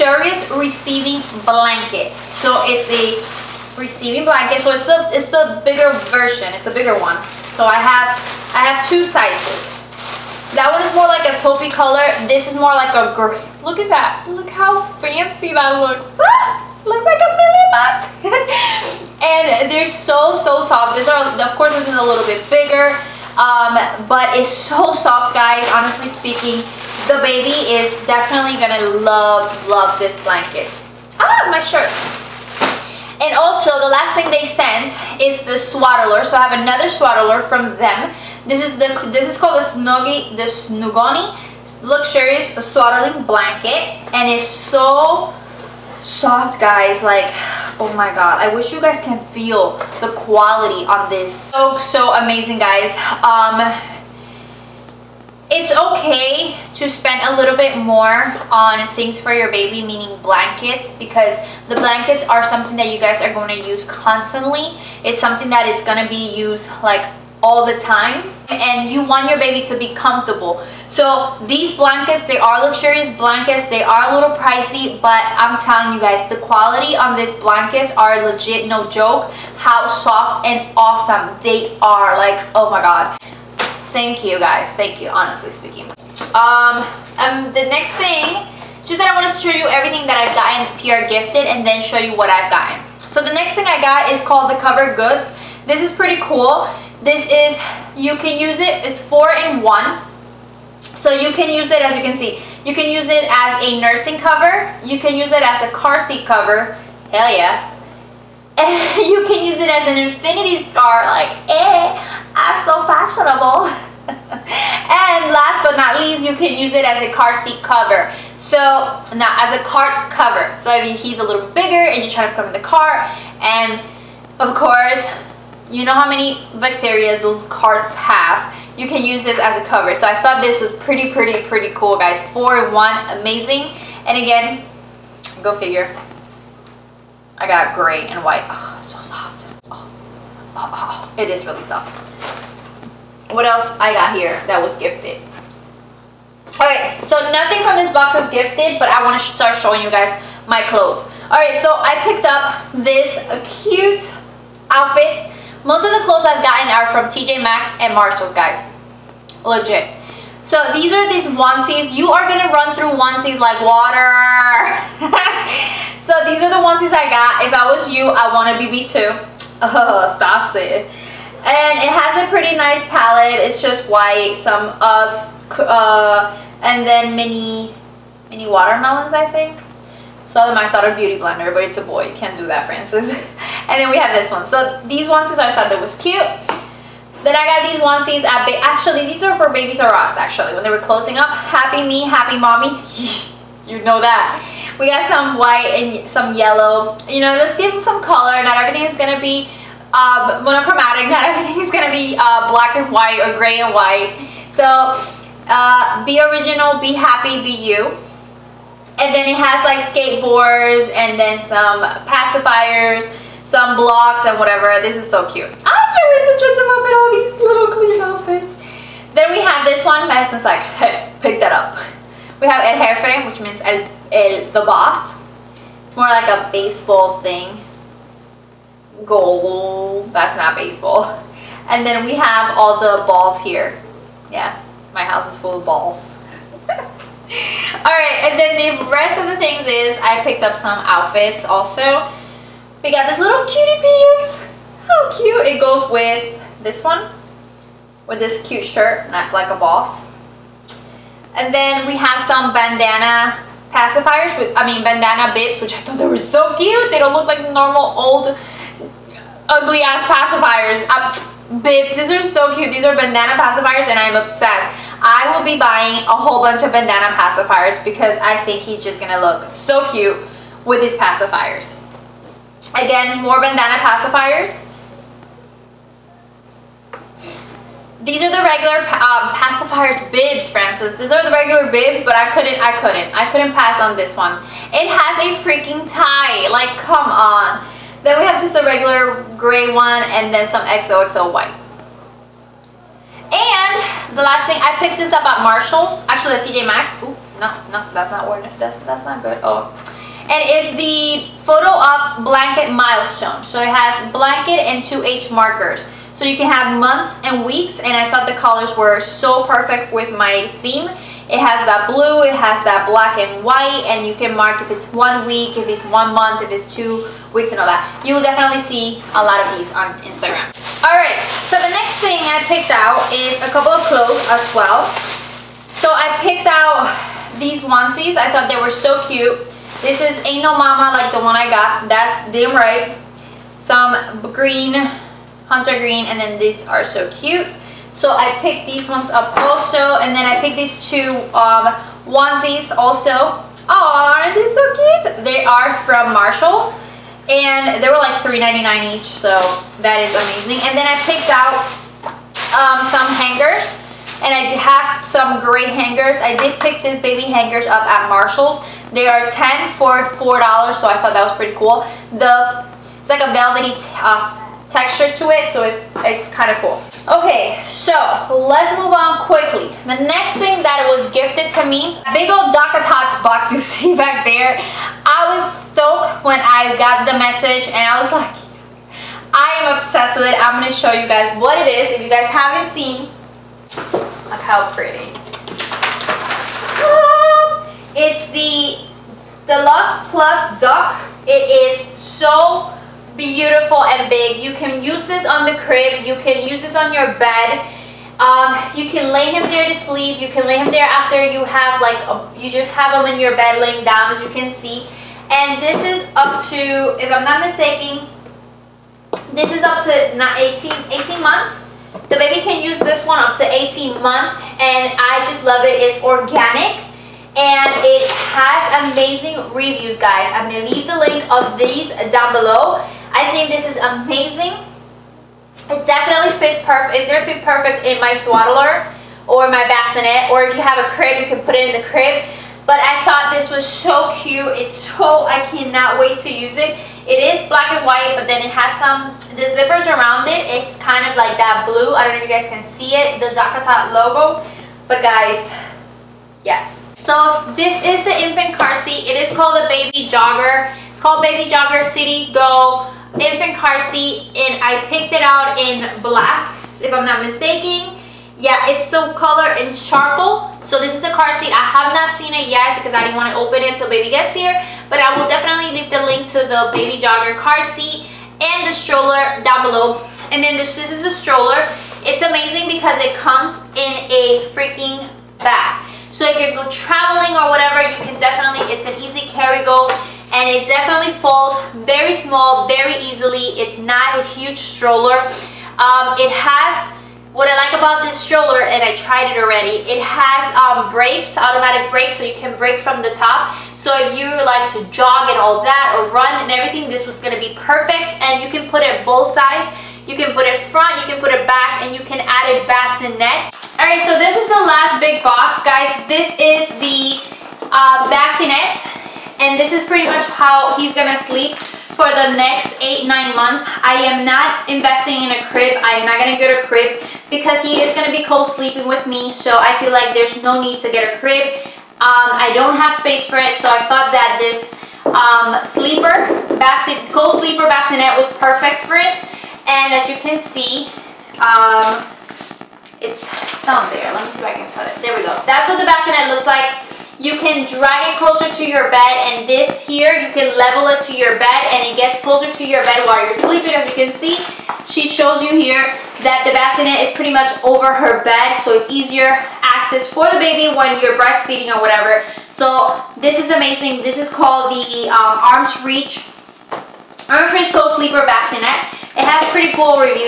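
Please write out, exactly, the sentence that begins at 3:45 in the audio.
It's more like a baseball thing.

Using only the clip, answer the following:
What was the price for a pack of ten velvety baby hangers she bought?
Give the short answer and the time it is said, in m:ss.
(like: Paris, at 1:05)
$4, at 5:59.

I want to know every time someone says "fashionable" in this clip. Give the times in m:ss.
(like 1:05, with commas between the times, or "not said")
1:52.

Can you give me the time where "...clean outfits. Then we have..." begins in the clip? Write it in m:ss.
3:37.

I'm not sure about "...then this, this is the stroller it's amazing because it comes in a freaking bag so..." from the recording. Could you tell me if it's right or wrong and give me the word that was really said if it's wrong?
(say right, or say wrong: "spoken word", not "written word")
right.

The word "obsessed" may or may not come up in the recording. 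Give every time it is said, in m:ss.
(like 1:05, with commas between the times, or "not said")
4:24, 6:19.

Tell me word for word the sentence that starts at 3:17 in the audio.
You know, just give them some color.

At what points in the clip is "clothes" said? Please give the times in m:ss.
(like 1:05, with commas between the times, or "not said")
2:30, 2:36, 5:23.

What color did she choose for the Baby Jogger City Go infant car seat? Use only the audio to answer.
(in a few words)
Charcoal.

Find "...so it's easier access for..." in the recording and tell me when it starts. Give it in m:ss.
9:08.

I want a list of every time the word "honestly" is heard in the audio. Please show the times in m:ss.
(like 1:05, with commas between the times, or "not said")
0:25, 1:25.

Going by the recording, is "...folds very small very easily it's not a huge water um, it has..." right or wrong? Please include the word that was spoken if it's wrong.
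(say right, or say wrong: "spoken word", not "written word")
wrong: "stroller", not "water".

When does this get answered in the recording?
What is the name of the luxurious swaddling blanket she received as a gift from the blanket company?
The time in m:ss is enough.
0:40.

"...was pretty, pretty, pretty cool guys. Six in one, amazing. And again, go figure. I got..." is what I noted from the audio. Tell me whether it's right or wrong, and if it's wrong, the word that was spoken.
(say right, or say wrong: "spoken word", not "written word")
wrong: "Four", not "Six".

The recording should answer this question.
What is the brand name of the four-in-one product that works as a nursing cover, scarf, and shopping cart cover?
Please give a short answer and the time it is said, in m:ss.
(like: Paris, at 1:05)
Cover Goods, at 1:34.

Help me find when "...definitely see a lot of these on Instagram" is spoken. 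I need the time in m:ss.
5:18.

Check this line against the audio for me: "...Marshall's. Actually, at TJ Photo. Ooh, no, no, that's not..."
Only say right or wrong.
wrong.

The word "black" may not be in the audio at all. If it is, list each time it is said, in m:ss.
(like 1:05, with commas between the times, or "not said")
3:22, 5:12, 7:17, 7:36.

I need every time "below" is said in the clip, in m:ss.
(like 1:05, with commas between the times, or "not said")
7:02, 7:49.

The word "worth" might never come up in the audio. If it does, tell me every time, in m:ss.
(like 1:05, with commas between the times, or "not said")
4:58.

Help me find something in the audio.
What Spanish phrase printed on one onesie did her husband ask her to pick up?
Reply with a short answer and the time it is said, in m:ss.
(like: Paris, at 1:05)
El Jefe, at 3:42.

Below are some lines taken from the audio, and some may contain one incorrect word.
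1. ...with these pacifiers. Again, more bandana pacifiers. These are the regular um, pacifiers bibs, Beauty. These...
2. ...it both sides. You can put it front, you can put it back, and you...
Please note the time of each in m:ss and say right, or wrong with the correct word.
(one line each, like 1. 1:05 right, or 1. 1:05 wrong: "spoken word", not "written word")
1. 4:30 wrong: "Francis", not "Beauty"
2. 8:18 right.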